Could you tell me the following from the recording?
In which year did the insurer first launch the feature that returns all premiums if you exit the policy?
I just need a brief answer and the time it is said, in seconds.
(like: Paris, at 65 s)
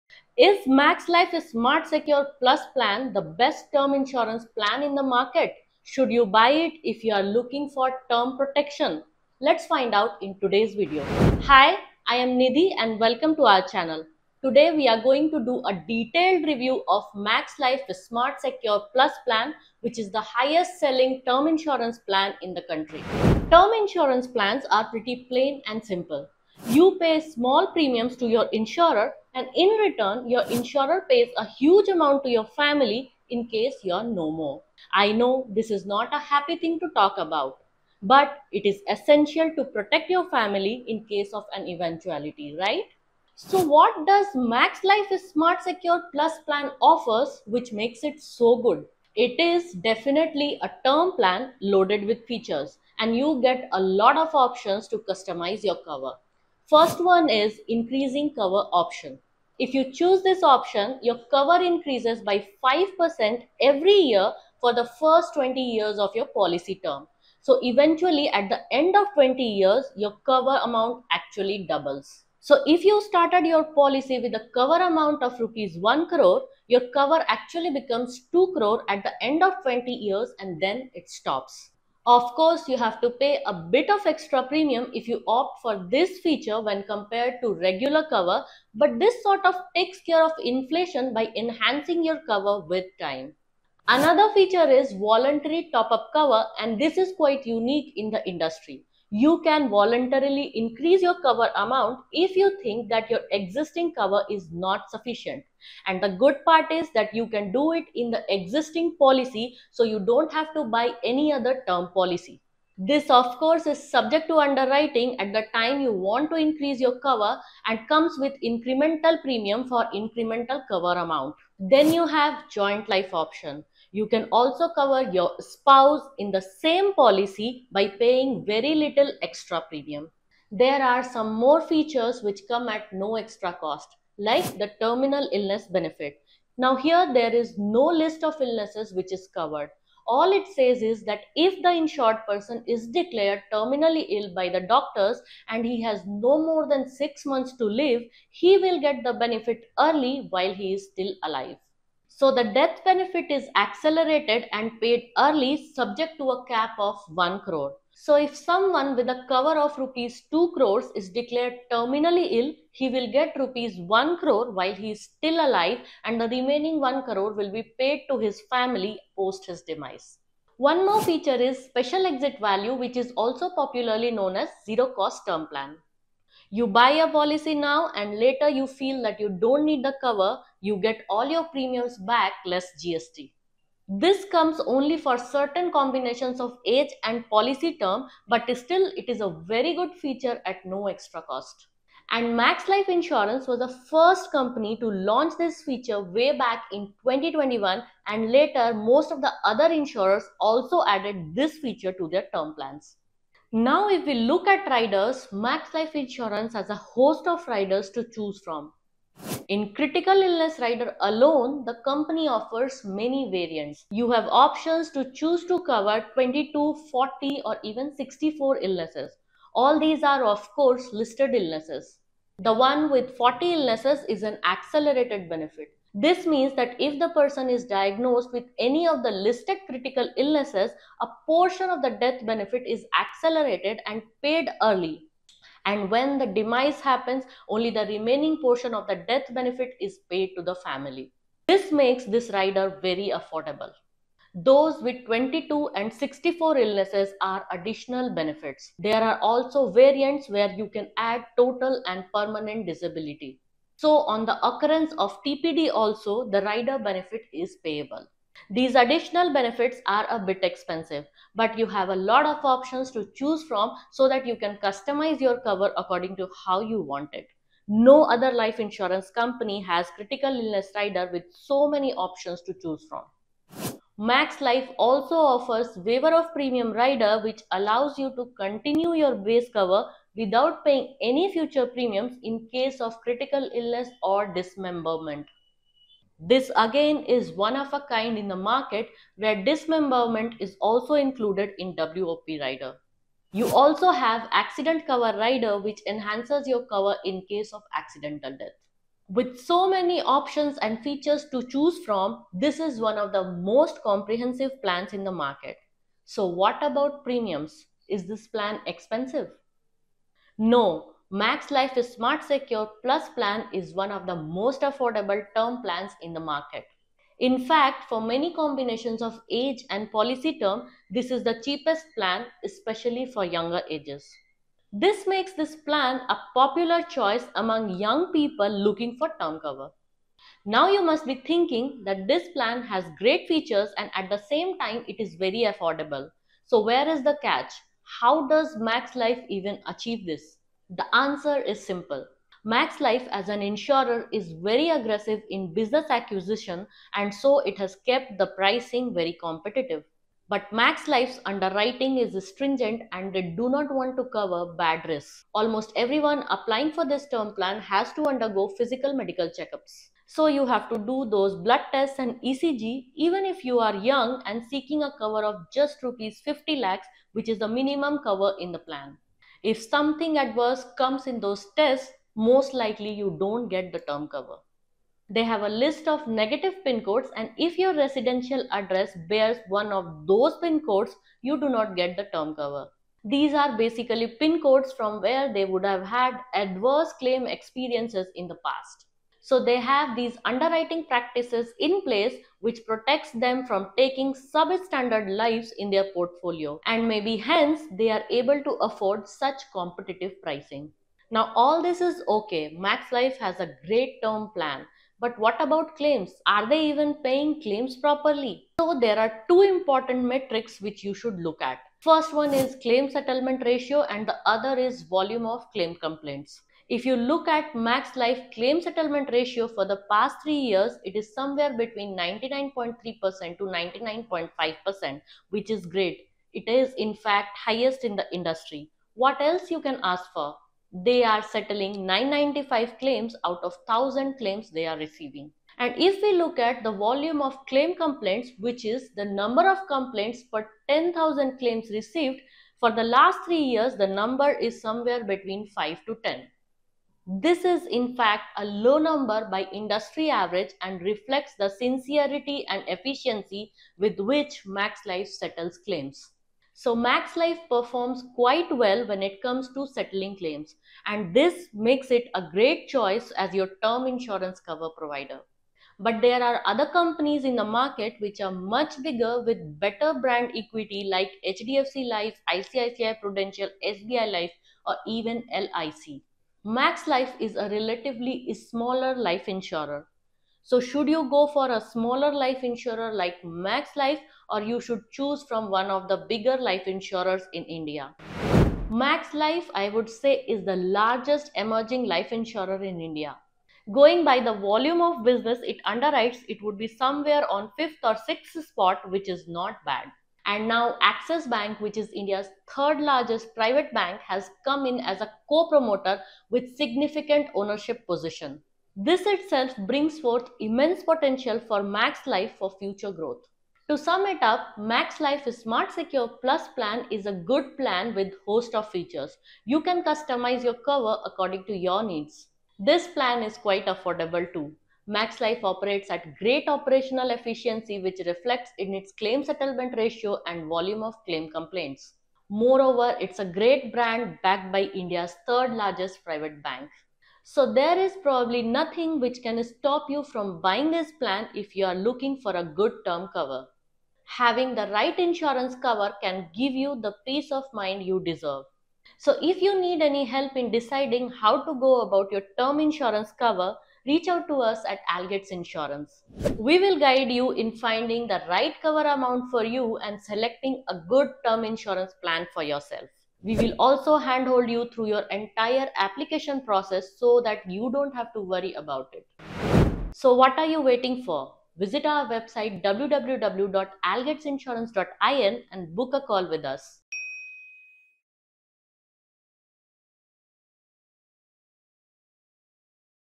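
2021, at 197 s.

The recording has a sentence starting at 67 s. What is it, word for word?
So eventually at the end of 20 years, your cover amount actually doubles.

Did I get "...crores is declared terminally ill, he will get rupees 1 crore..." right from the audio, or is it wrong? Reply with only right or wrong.
right.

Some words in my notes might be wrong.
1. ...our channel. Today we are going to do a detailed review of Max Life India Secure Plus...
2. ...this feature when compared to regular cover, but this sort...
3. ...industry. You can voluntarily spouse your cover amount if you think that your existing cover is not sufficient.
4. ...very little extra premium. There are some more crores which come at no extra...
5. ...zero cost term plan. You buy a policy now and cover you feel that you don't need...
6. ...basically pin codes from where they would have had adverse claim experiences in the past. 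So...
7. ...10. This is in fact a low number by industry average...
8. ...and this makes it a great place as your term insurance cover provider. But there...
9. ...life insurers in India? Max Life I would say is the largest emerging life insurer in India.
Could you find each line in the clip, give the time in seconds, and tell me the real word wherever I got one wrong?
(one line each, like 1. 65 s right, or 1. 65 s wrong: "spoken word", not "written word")
1. 13 s wrong: "Smart", not "India"
2. 85 s right
3. 98 s wrong: "increase", not "spouse"
4. 128 s wrong: "features", not "crores"
5. 174 s wrong: "later", not "cover"
6. 383 s right
7. 446 s right
8. 460 s wrong: "choice", not "place"
9. 486 s right.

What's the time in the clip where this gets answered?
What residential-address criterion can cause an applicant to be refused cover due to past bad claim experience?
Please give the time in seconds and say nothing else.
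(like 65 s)
376 s.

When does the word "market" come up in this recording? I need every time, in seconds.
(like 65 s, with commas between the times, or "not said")
5 s, 288 s, 305 s, 316 s, 467 s.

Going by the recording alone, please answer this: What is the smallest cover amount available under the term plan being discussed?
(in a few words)
50 lakhs.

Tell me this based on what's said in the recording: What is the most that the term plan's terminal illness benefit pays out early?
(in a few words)
1 crore.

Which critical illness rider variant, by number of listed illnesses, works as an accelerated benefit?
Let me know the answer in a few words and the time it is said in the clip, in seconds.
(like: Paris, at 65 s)
40 illnesses, at 222 s.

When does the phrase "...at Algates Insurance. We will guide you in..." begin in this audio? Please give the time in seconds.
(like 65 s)
554 s.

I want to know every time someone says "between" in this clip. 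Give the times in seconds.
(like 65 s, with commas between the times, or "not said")
421 s, 445 s.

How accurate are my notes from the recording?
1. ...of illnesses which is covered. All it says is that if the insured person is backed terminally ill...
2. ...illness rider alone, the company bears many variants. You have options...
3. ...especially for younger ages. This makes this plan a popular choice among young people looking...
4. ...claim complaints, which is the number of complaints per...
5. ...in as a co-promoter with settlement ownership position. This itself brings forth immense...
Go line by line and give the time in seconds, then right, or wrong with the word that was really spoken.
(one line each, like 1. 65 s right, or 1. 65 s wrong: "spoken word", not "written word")
1. 138 s wrong: "declared", not "backed"
2. 210 s wrong: "offers", not "bears"
3. 322 s right
4. 437 s right
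5. 504 s wrong: "significant", not "settlement".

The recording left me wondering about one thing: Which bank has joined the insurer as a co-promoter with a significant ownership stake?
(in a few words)
Axis Bank.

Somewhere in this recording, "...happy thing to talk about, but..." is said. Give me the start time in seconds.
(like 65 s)
36 s.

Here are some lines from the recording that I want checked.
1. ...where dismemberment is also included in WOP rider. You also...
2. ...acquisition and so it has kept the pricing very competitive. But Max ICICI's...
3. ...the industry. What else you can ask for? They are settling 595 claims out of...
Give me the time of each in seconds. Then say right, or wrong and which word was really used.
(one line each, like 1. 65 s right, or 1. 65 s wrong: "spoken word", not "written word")
1. 289 s right
2. 345 s wrong: "Life", not "ICICI"
3. 427 s wrong: "995", not "595".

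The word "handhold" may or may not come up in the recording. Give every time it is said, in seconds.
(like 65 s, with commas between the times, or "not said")
563 s.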